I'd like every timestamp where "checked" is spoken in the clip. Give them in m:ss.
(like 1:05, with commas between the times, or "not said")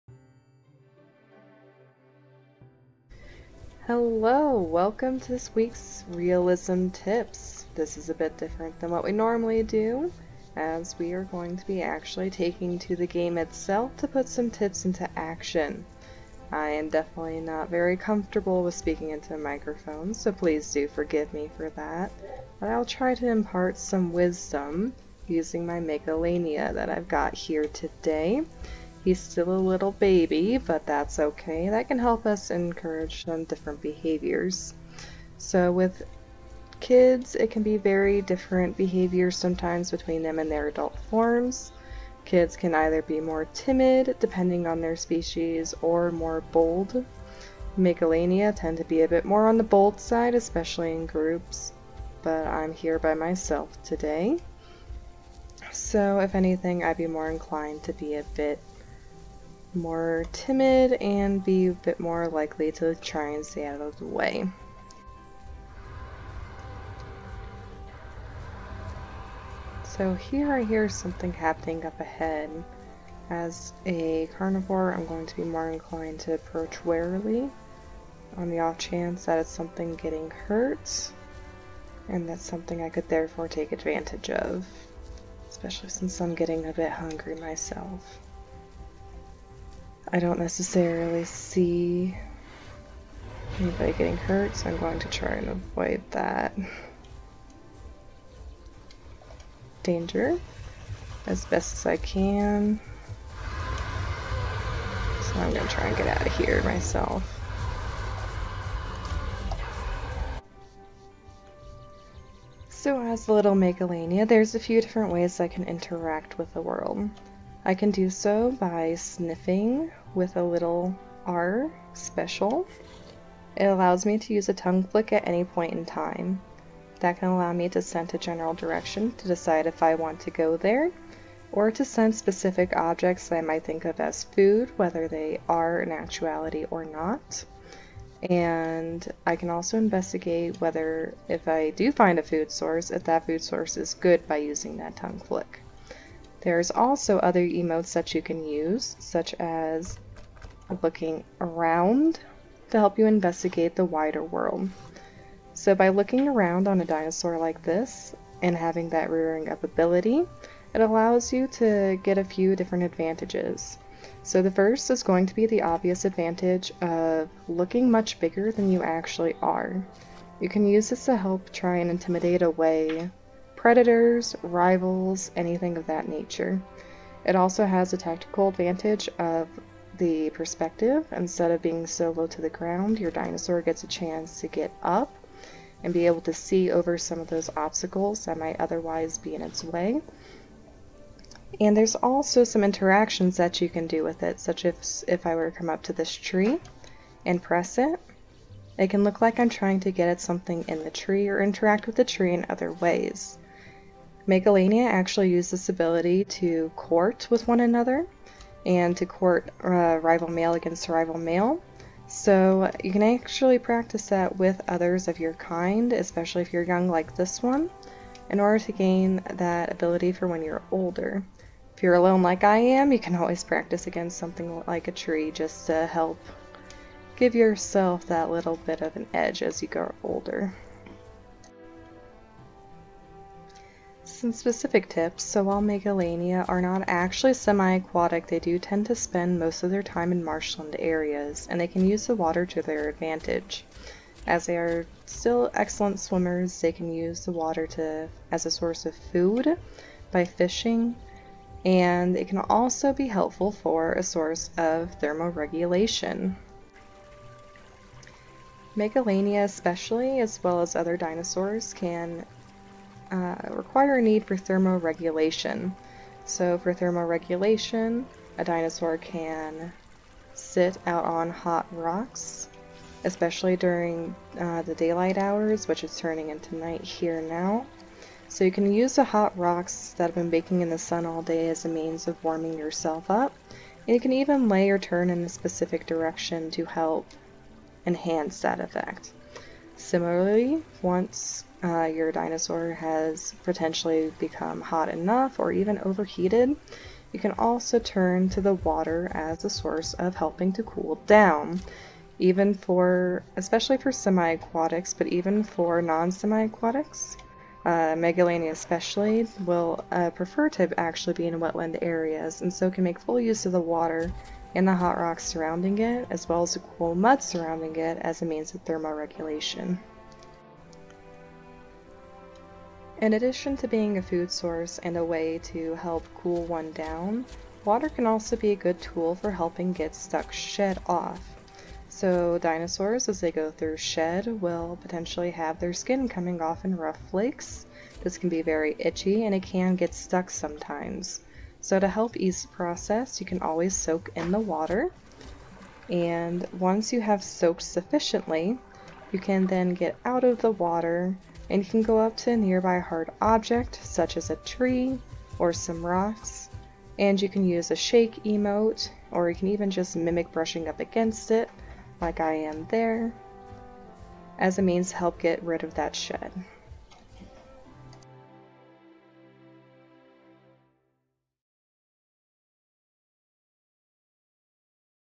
not said.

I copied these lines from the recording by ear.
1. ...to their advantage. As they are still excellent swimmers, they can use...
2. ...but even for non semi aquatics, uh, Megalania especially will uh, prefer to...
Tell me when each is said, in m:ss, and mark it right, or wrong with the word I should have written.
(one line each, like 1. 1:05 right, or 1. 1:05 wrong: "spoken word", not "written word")
1. 4:02 right
2. 5:04 right.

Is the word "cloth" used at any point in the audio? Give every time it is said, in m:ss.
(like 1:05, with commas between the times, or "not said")
not said.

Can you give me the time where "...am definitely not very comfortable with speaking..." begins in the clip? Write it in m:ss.
0:16.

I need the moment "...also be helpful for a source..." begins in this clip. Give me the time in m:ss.
4:12.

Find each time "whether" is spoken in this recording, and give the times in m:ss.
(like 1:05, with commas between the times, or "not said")
2:14, 2:20.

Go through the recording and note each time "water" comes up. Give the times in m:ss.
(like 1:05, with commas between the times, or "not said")
4:02, 4:07, 4:58, 5:13, 5:27, 5:44, 5:50.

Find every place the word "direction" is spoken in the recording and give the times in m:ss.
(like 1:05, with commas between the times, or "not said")
2:08, 4:45.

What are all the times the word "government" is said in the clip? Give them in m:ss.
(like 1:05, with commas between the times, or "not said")
not said.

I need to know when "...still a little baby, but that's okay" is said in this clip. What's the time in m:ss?
0:29.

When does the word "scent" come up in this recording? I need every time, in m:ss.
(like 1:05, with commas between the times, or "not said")
2:07, 2:11.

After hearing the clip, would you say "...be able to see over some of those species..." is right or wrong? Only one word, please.
wrong.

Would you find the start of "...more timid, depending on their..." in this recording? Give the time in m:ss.
0:43.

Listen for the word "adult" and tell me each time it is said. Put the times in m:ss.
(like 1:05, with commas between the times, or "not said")
0:40.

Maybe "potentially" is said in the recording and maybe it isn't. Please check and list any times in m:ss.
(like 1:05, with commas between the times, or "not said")
4:53, 5:34.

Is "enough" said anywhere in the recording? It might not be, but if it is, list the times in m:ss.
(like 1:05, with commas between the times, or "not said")
4:54.